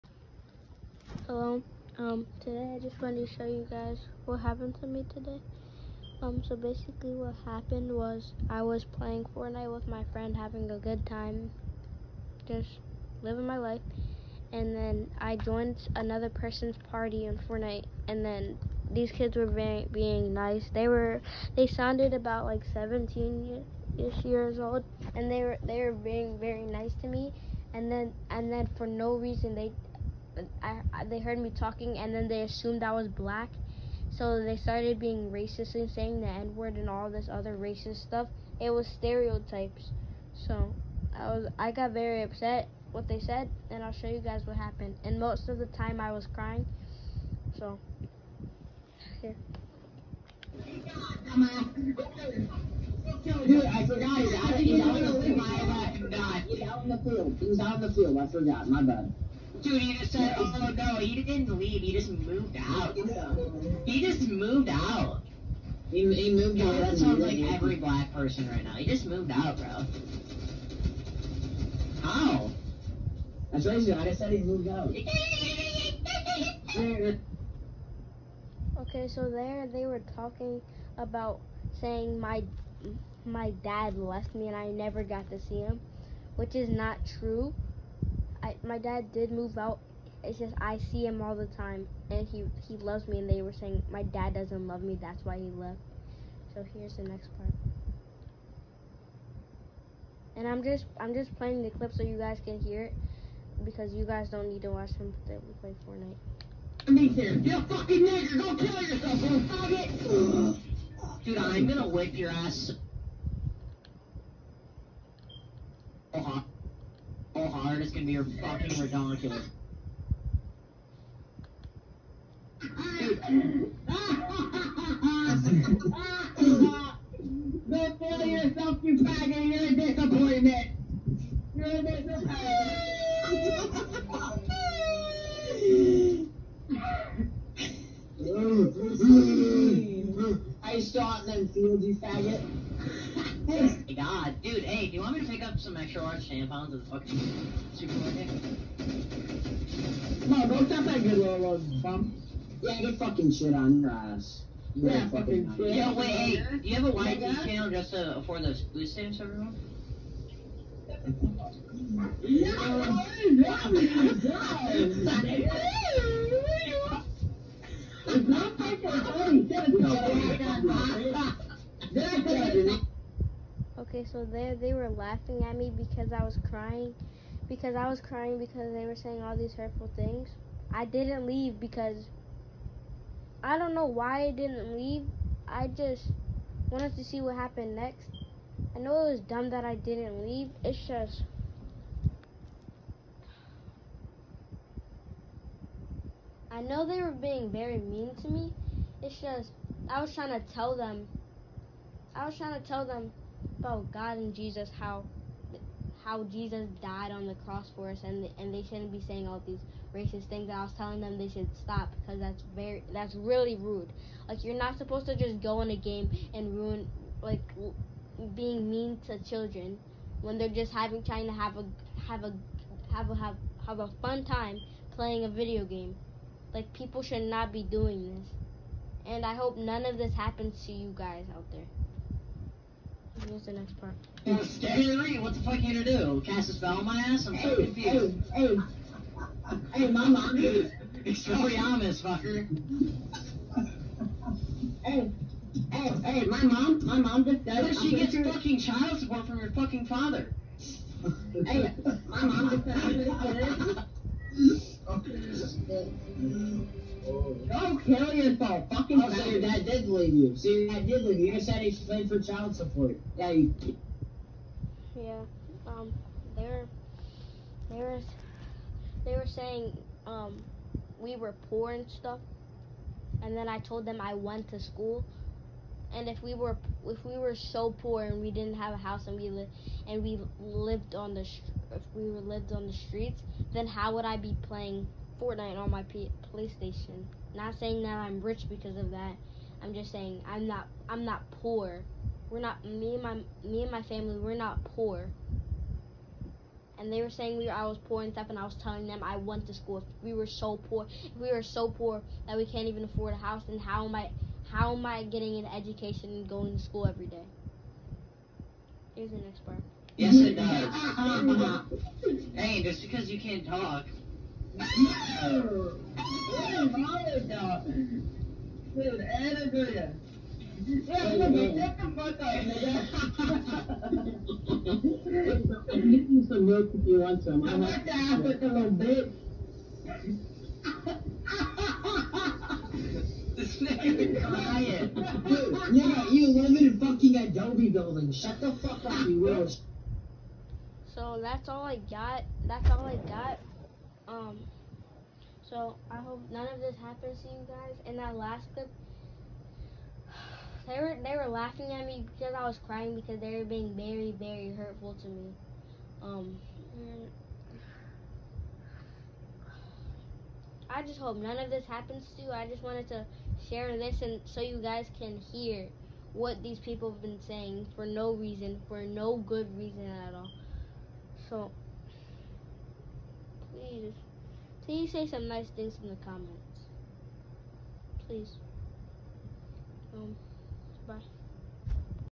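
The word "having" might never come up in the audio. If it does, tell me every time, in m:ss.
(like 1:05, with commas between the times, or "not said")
0:10, 3:40.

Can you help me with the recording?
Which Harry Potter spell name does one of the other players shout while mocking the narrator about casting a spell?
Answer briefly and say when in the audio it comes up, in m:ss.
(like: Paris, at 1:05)
Expelliarmus, at 4:01.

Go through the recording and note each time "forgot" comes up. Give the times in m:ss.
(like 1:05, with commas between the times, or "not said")
0:53, 0:58.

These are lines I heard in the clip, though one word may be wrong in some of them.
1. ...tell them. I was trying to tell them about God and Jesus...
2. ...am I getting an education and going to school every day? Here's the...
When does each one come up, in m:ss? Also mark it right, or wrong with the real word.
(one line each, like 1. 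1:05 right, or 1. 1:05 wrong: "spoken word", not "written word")
1. 3:20 right
2. 5:04 right.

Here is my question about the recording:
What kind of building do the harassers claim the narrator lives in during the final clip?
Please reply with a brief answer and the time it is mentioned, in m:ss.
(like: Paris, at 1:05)
Adobe building, at 5:37.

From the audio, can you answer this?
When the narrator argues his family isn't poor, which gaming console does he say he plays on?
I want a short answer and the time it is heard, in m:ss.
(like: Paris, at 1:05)
PlayStation, at 4:46.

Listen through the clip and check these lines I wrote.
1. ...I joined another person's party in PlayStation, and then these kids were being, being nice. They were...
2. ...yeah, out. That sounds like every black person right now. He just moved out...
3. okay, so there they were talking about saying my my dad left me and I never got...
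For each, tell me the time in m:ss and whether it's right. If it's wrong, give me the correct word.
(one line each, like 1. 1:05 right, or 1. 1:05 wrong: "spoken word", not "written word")
1. 0:15 wrong: "Fortnite", not "PlayStation"
2. 1:06 right
3. 1:18 right.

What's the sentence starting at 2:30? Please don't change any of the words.
No, bro, it's not that good, little rose bump.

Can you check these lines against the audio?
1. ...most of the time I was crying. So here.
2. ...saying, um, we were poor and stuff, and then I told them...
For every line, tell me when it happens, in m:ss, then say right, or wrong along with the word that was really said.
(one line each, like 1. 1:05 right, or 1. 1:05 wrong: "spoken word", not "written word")
1. 0:45 right
2. 4:29 right.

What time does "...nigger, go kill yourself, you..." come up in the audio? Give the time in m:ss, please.
1:48.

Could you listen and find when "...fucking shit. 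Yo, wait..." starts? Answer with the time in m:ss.
2:35.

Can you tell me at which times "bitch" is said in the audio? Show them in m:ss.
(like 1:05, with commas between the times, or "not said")
5:28.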